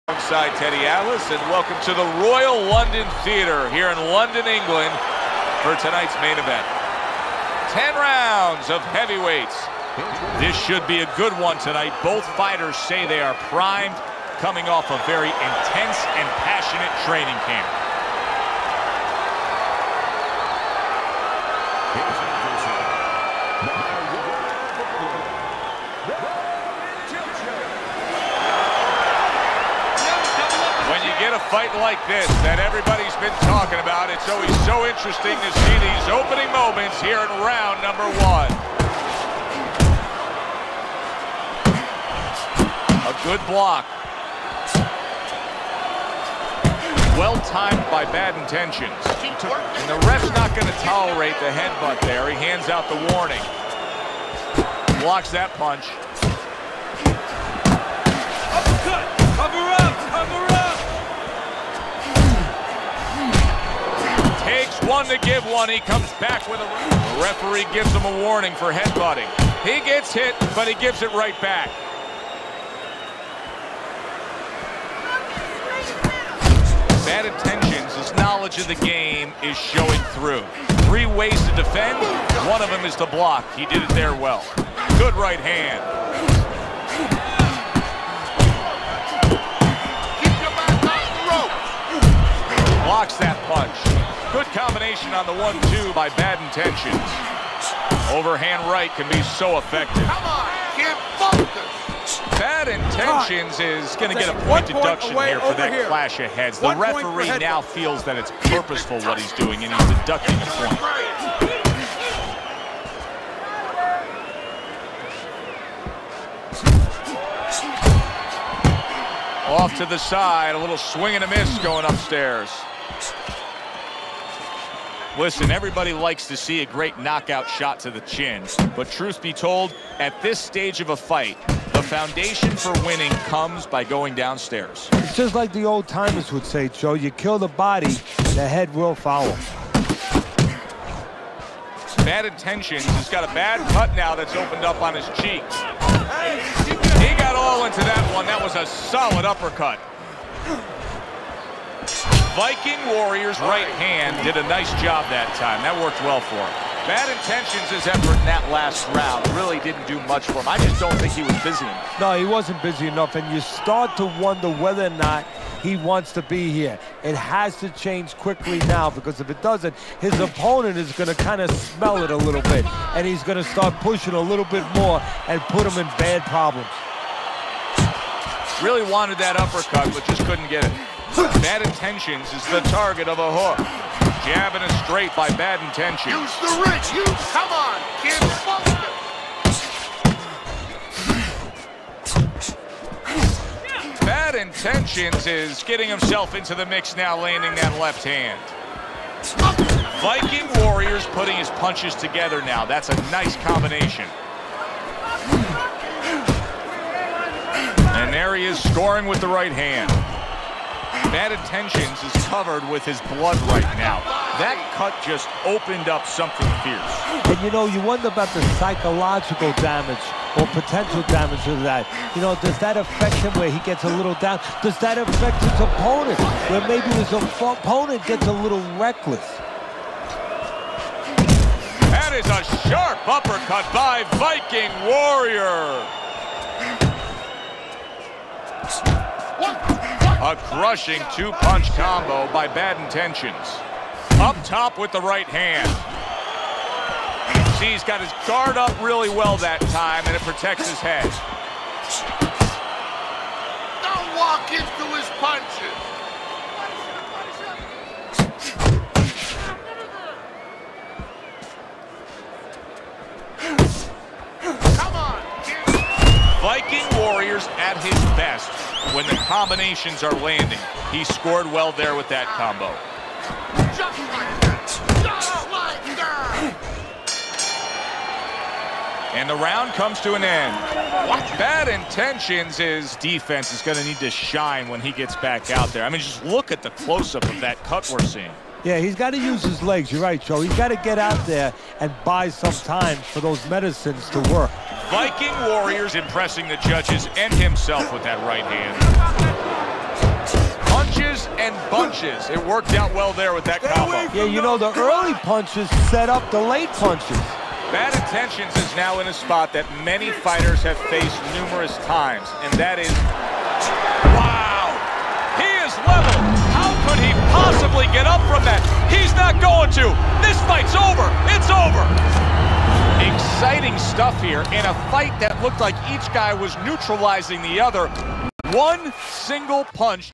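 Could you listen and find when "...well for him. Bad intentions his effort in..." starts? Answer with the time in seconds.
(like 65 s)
156 s.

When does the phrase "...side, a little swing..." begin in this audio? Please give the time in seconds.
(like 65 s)
119 s.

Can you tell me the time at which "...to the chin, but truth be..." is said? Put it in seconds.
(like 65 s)
127 s.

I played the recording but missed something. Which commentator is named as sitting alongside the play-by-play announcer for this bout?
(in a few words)
Teddy Atlas.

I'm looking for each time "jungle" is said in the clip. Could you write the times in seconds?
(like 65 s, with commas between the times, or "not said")
not said.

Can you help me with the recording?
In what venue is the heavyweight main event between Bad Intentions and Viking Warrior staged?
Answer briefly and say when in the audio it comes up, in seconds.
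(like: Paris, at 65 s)
Royal London Theatre, at 2 s.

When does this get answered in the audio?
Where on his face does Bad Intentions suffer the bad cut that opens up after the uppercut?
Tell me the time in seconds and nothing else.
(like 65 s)
145 s.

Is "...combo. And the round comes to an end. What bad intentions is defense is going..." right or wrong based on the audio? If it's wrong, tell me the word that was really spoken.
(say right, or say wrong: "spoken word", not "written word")
right.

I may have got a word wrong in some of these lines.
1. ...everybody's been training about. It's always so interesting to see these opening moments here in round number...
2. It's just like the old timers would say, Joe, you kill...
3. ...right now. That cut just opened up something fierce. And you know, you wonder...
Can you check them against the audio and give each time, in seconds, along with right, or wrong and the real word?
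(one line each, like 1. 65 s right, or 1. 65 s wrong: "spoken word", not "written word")
1. 32 s wrong: "talking", not "training"
2. 134 s right
3. 213 s right.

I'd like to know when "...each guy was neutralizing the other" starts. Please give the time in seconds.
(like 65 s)
325 s.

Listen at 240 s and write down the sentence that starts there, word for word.
A crushing two-punch combo by Bad Intentions.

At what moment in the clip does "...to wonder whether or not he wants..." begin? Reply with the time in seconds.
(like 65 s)
163 s.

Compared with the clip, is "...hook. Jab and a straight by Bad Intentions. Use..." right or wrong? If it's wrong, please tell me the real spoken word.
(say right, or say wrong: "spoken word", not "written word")
right.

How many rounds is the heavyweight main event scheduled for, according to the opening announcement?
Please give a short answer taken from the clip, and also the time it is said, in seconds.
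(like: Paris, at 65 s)
10, at 7 s.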